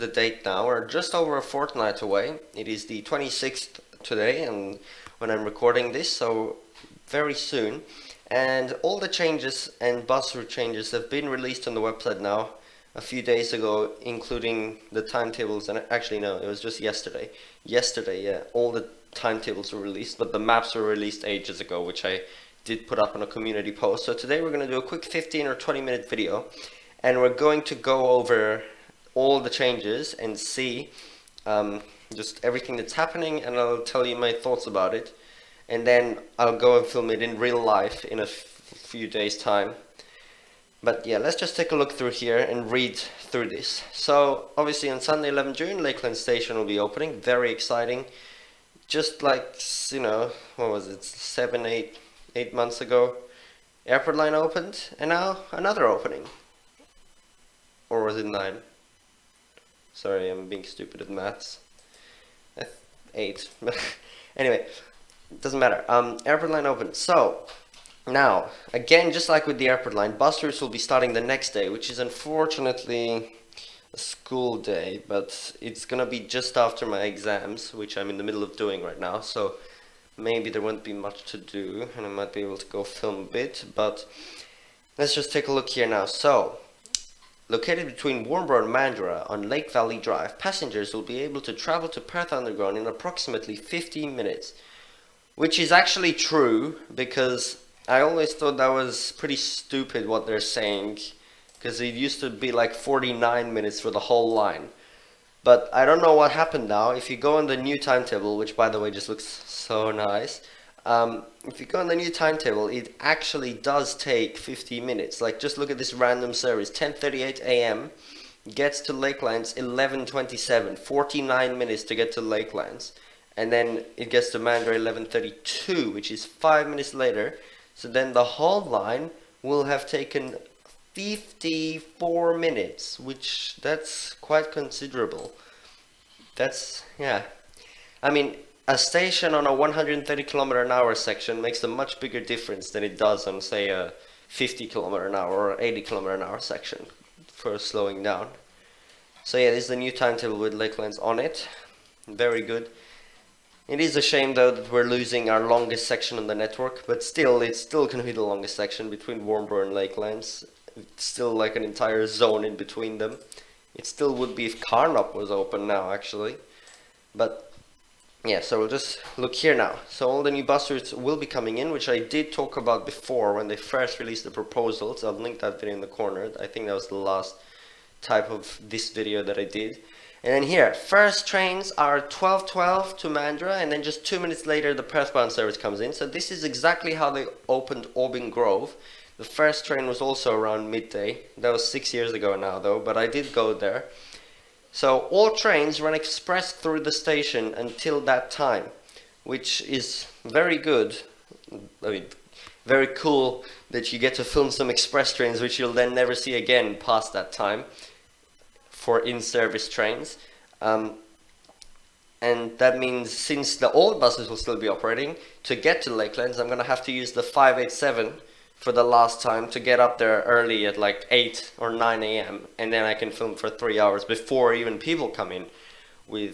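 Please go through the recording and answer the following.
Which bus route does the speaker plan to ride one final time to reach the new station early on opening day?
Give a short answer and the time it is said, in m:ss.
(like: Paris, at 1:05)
587, at 3:37.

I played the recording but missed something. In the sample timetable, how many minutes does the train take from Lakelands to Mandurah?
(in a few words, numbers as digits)
5 minutes.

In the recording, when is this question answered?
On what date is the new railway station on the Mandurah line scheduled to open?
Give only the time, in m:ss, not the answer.
0:45.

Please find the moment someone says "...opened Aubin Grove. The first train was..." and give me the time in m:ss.
3:07.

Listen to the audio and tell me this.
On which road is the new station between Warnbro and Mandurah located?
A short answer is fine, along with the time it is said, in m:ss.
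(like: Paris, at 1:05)
Lake Valley Drive, at 1:29.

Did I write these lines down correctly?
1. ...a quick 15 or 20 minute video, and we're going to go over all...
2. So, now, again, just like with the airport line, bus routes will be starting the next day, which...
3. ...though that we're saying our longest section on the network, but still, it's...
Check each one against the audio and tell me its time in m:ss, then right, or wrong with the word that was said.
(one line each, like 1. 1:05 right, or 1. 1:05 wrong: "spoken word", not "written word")
1. 0:24 right
2. 1:06 right
3. 2:34 wrong: "losing", not "saying".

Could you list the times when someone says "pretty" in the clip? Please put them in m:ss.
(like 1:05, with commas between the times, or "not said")
1:39.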